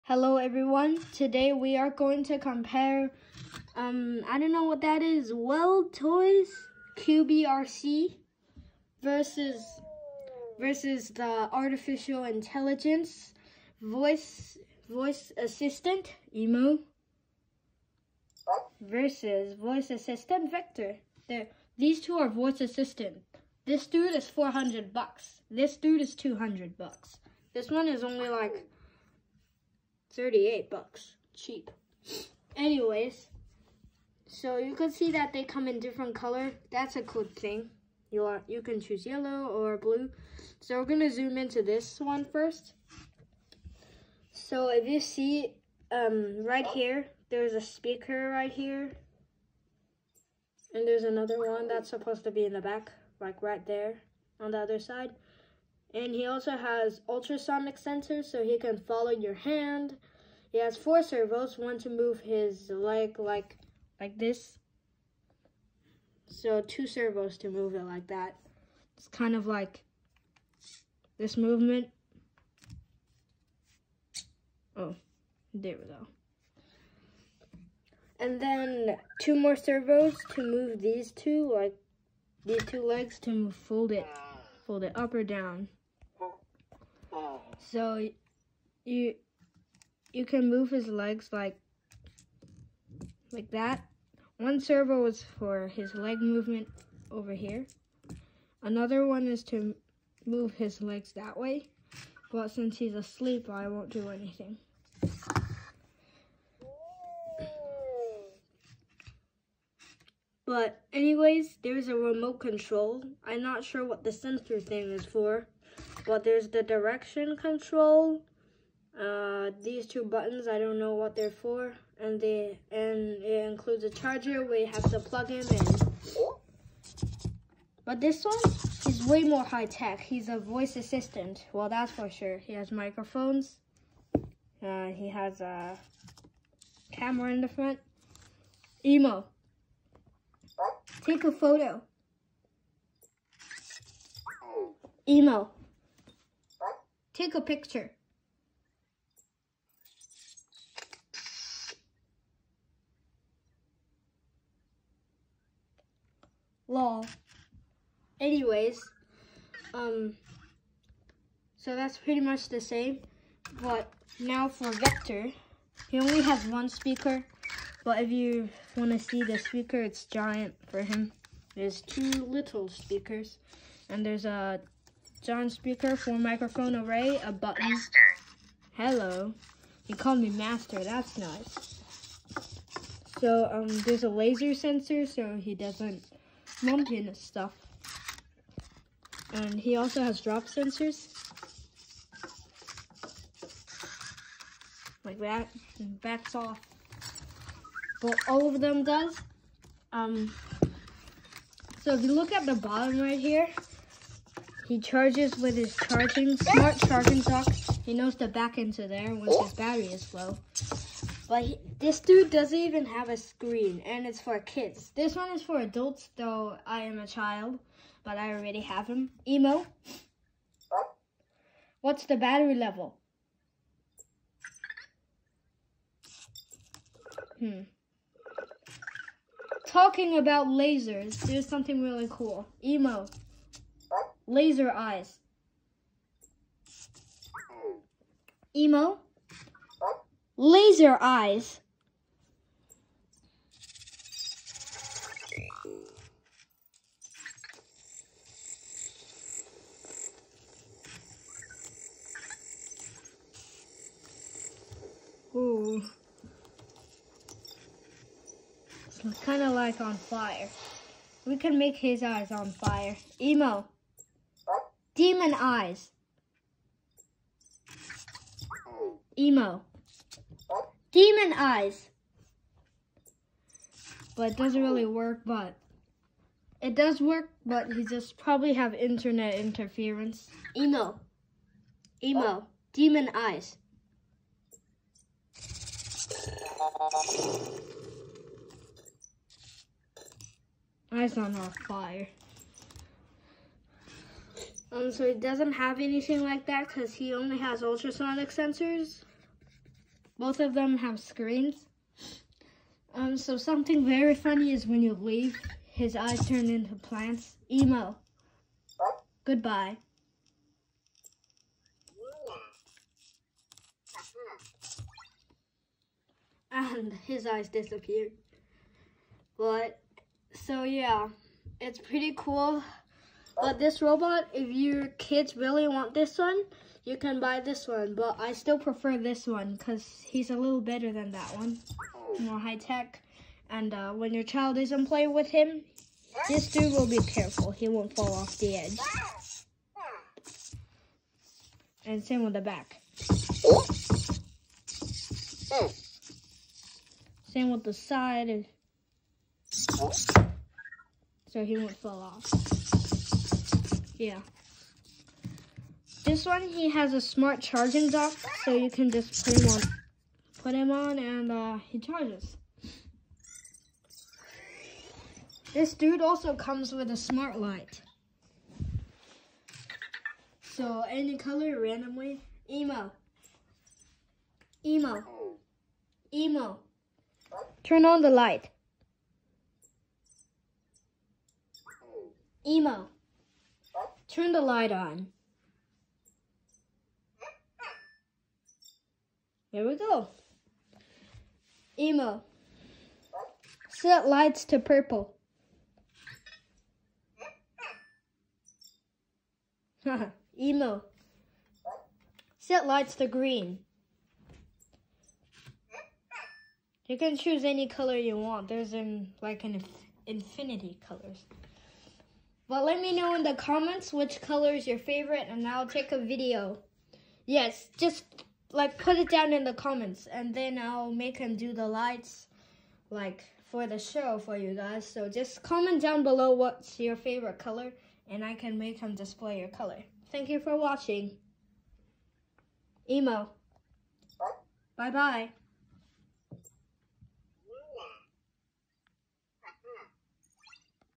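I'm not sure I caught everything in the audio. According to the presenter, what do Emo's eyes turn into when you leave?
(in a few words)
plants.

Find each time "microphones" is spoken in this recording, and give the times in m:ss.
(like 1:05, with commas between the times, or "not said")
2:12, 2:56.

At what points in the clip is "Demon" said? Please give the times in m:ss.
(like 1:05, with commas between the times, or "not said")
4:24, 4:30, 4:42.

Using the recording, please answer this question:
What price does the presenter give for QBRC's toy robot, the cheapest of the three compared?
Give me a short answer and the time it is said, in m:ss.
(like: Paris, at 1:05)
$38, at 0:30.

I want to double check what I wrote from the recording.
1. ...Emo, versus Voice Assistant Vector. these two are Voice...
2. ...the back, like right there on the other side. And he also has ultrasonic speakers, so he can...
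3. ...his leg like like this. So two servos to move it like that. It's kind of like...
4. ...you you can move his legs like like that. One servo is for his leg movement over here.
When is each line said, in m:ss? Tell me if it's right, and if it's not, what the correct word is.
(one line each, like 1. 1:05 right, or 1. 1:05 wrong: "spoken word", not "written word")
1. 0:16 right
2. 0:52 wrong: "sensors", not "speakers"
3. 1:02 right
4. 1:28 right.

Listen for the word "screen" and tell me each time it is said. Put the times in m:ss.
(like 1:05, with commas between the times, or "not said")
3:33, 5:00.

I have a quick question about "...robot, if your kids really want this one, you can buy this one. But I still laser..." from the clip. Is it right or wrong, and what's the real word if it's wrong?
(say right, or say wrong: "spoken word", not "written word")
wrong: "prefer", not "laser".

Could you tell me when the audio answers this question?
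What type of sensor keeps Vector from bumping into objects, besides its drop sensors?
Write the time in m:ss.
3:04.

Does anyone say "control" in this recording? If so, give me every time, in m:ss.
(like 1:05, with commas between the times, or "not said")
1:52, 1:57.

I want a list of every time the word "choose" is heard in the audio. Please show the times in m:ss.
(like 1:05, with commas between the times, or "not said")
0:38, 6:47.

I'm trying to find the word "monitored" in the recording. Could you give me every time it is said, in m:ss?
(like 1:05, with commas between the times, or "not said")
not said.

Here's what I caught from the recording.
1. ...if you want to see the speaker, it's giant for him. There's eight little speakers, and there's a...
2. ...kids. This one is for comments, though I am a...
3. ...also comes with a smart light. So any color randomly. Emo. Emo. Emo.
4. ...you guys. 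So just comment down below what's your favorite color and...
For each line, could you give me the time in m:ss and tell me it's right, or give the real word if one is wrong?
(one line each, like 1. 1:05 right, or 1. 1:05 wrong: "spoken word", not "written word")
1. 2:47 wrong: "two", not "eight"
2. 3:34 wrong: "adults", not "comments"
3. 6:06 right
4. 7:04 right.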